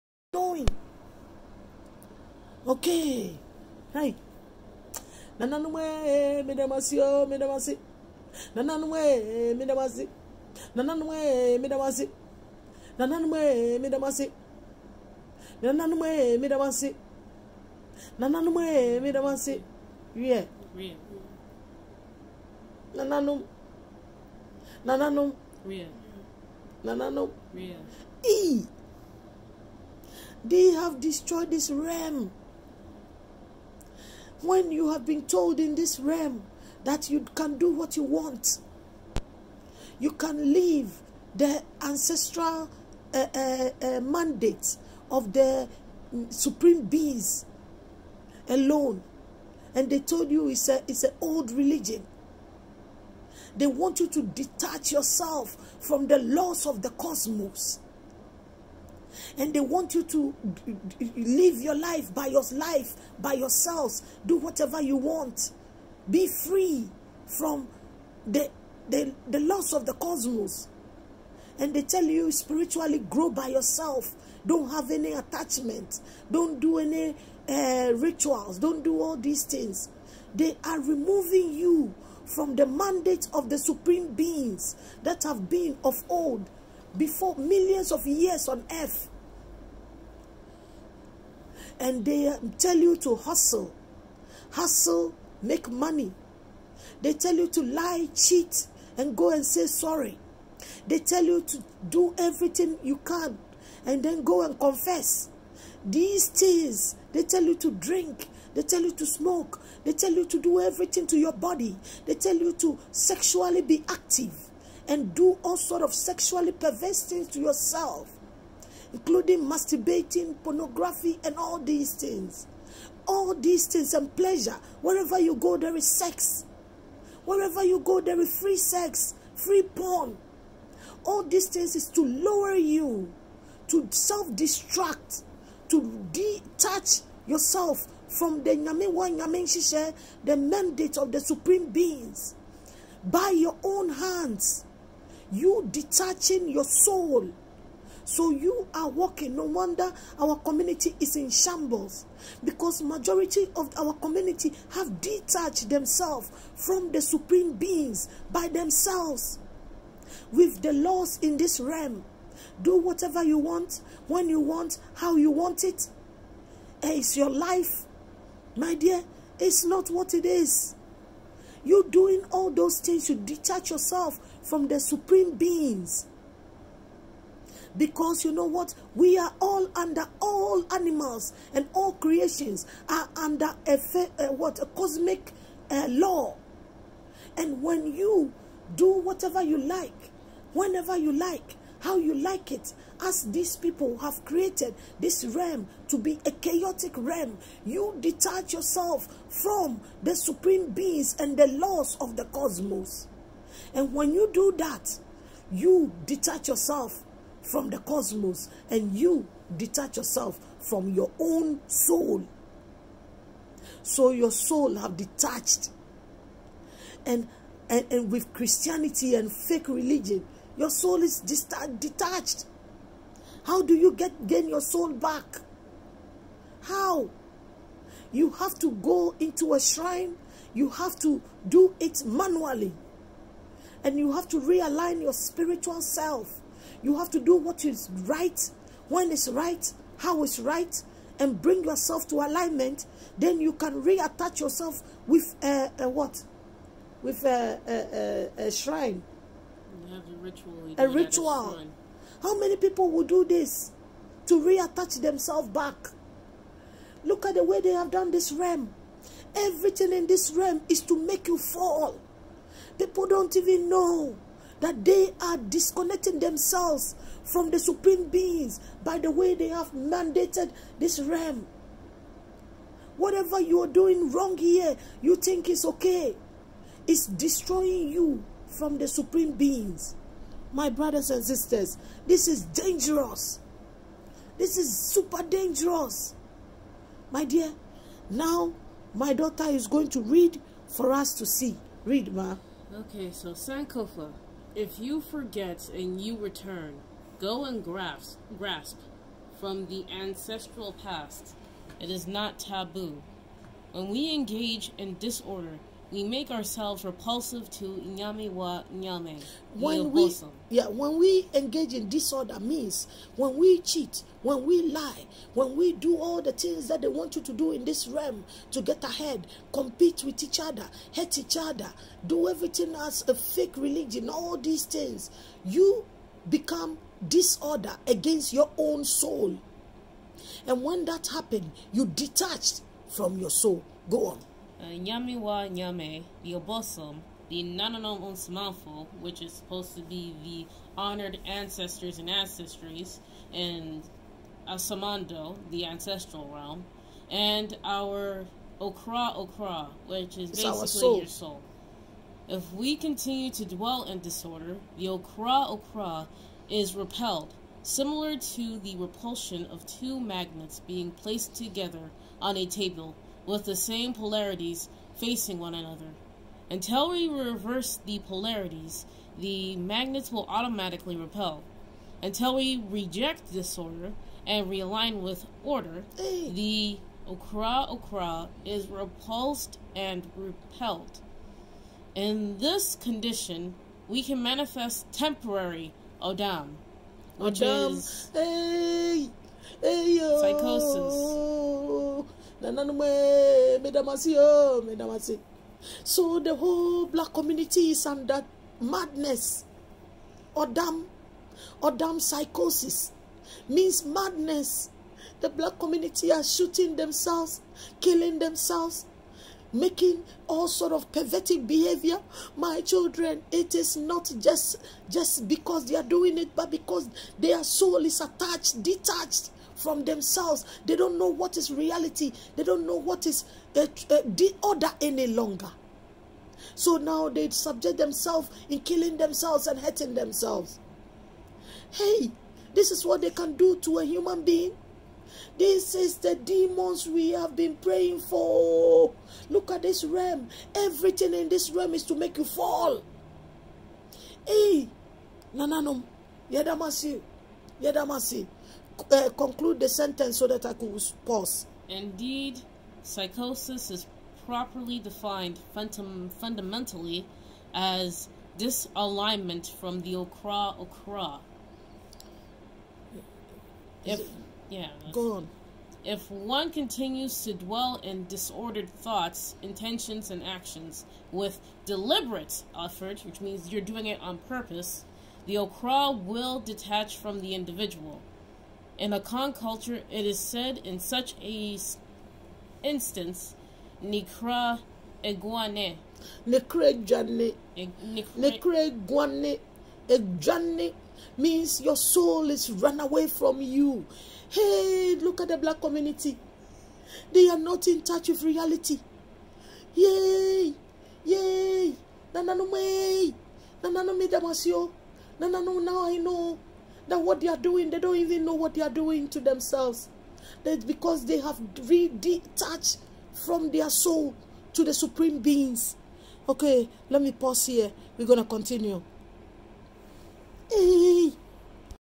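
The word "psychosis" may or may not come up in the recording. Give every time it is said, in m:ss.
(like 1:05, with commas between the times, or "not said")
6:30, 6:42, 7:32.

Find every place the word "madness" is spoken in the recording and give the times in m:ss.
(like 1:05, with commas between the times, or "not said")
6:38, 6:43.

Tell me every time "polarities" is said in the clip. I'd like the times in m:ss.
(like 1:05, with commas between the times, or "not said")
6:03, 6:07.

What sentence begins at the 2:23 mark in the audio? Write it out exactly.
By your own hands, you detaching your soul so you are working.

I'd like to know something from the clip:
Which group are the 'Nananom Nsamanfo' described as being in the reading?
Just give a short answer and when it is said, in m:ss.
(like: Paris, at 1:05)
Honored ancestors, at 5:40.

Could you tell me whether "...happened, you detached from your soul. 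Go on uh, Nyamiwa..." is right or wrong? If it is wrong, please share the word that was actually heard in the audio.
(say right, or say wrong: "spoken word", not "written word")
right.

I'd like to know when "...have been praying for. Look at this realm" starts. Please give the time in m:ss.
7:17.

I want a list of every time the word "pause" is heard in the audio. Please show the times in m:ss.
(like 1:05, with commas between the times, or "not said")
7:31, 8:37.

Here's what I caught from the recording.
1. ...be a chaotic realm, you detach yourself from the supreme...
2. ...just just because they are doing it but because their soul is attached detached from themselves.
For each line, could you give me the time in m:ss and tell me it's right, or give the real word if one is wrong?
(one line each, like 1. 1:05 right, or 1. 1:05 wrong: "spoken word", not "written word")
1. 3:15 right
2. 6:54 right.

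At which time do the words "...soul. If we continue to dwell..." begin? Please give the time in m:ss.
5:51.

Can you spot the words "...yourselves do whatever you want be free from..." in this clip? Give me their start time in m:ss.
1:03.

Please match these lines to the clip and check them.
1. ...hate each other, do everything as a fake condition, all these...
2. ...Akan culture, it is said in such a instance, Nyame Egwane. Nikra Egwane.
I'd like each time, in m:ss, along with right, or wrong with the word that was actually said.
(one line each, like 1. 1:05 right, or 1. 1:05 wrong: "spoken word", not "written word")
1. 5:20 wrong: "religion", not "condition"
2. 7:58 wrong: "Nikra", not "Nyame".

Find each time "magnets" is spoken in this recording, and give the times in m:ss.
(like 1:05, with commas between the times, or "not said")
5:59, 6:09.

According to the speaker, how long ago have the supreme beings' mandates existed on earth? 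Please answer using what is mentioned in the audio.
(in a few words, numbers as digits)
Millions of years.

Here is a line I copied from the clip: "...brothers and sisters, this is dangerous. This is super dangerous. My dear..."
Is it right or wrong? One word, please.
right.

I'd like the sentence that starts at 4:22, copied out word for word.
People don't even know that they are disconnecting themselves from the supreme beings by the way they have mandated this realm.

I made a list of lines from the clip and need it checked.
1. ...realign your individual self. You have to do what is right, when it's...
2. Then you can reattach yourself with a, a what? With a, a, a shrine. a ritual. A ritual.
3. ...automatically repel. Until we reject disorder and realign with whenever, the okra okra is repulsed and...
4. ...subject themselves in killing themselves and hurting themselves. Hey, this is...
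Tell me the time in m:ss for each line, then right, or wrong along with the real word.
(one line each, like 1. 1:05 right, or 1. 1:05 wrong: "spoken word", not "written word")
1. 3:54 wrong: "spiritual", not "individual"
2. 4:03 right
3. 6:10 wrong: "order", not "whenever"
4. 7:07 right.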